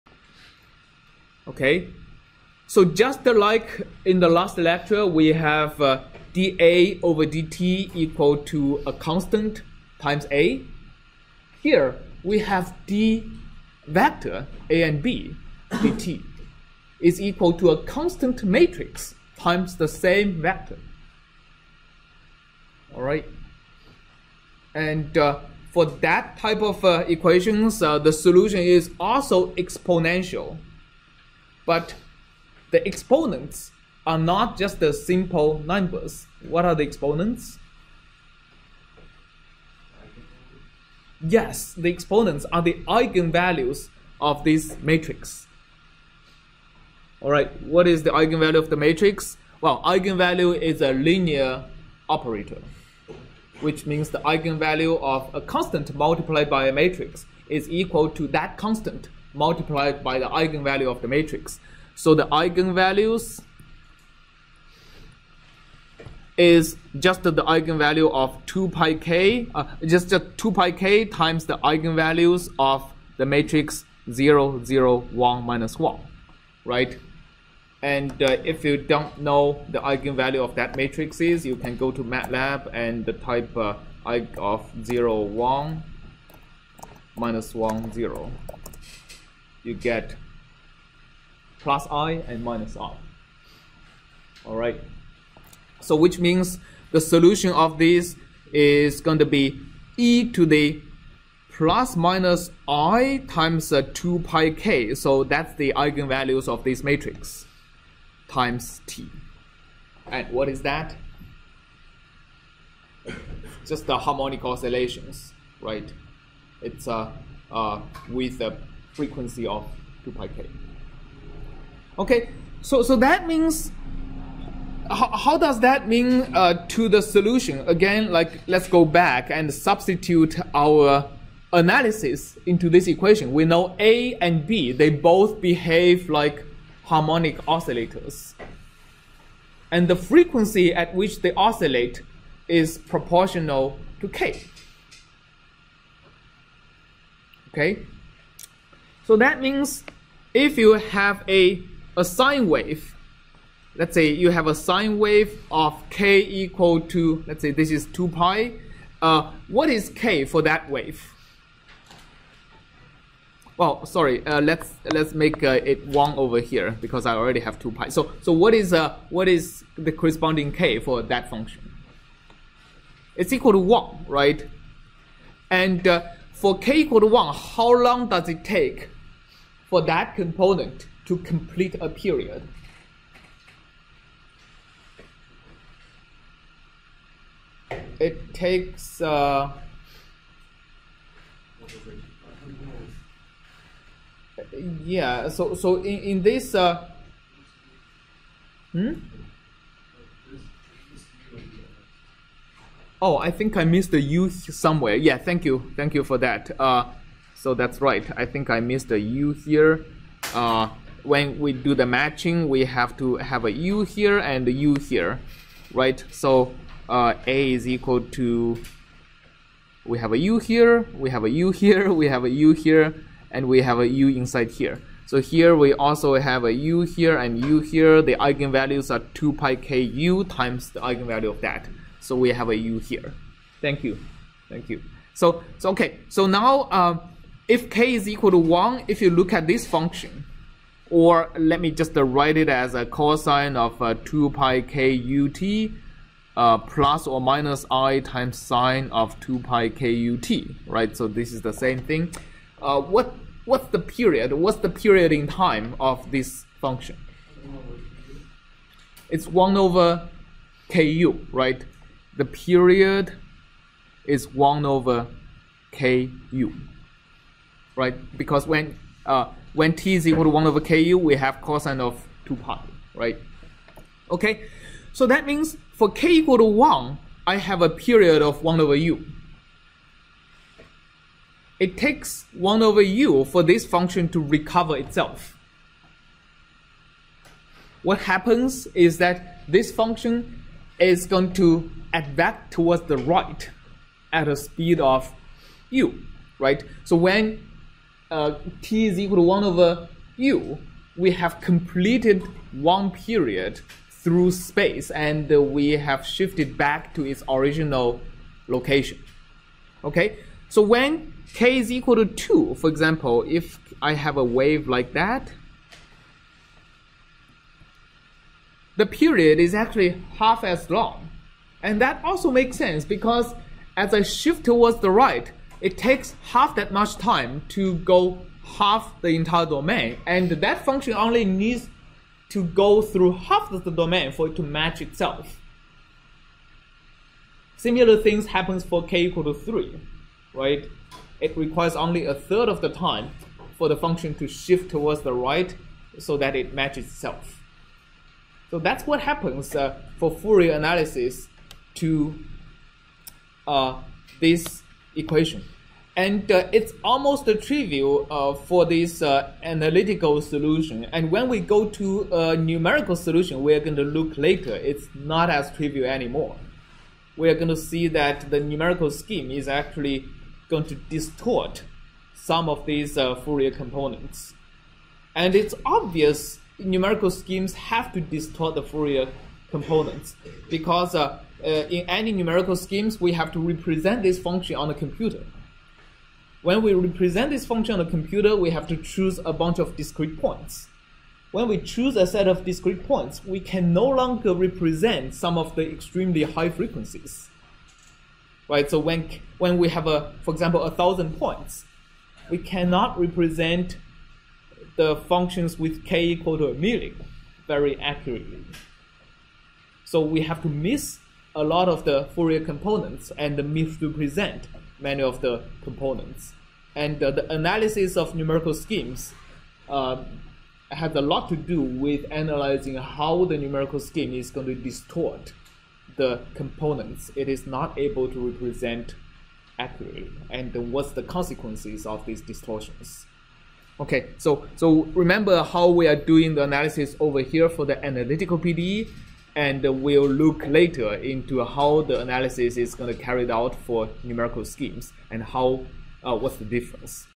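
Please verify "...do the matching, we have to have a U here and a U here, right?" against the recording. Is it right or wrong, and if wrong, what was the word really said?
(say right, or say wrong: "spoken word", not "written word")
right.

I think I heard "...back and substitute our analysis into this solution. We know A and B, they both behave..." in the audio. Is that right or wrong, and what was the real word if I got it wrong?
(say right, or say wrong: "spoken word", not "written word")
wrong: "equation", not "solution".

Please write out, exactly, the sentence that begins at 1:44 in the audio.
So that's the eigenvalues of this matrix times t.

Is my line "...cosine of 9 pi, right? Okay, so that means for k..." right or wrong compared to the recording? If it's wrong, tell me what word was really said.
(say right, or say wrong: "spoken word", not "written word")
wrong: "2", not "9".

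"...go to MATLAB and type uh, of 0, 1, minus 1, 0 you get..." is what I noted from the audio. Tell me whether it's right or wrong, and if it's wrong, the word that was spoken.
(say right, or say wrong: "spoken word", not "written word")
right.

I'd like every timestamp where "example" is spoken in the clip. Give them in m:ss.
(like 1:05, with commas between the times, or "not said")
5:12, 6:40.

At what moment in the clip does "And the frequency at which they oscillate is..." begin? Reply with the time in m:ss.
2:19.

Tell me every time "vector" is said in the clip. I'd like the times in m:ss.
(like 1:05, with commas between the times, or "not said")
0:13, 0:20.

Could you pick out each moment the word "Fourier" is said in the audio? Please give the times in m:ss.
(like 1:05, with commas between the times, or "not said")
5:50, 6:13, 6:18, 6:52.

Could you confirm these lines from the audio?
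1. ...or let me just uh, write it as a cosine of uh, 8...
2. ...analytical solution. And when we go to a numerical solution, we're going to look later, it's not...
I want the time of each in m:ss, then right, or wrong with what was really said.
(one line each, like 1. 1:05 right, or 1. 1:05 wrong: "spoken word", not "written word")
1. 4:00 wrong: "2", not "8"
2. 5:59 right.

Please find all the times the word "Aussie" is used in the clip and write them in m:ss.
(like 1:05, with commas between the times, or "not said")
not said.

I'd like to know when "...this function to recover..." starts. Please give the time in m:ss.
4:43.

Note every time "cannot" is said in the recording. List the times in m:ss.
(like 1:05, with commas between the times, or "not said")
6:42.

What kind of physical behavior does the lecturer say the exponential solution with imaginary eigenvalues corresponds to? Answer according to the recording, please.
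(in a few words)
harmonic oscillations.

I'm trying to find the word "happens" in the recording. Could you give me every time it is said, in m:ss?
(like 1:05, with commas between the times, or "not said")
4:47, 5:38, 5:49.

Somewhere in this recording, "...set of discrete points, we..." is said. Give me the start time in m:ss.
6:32.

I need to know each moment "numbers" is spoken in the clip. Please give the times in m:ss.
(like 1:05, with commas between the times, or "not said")
0:35.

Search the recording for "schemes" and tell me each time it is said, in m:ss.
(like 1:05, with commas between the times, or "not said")
6:08, 6:17, 6:22, 6:58, 7:03, 7:24.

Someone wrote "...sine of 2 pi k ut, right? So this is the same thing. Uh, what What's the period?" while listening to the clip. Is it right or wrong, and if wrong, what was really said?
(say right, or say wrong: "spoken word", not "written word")
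right.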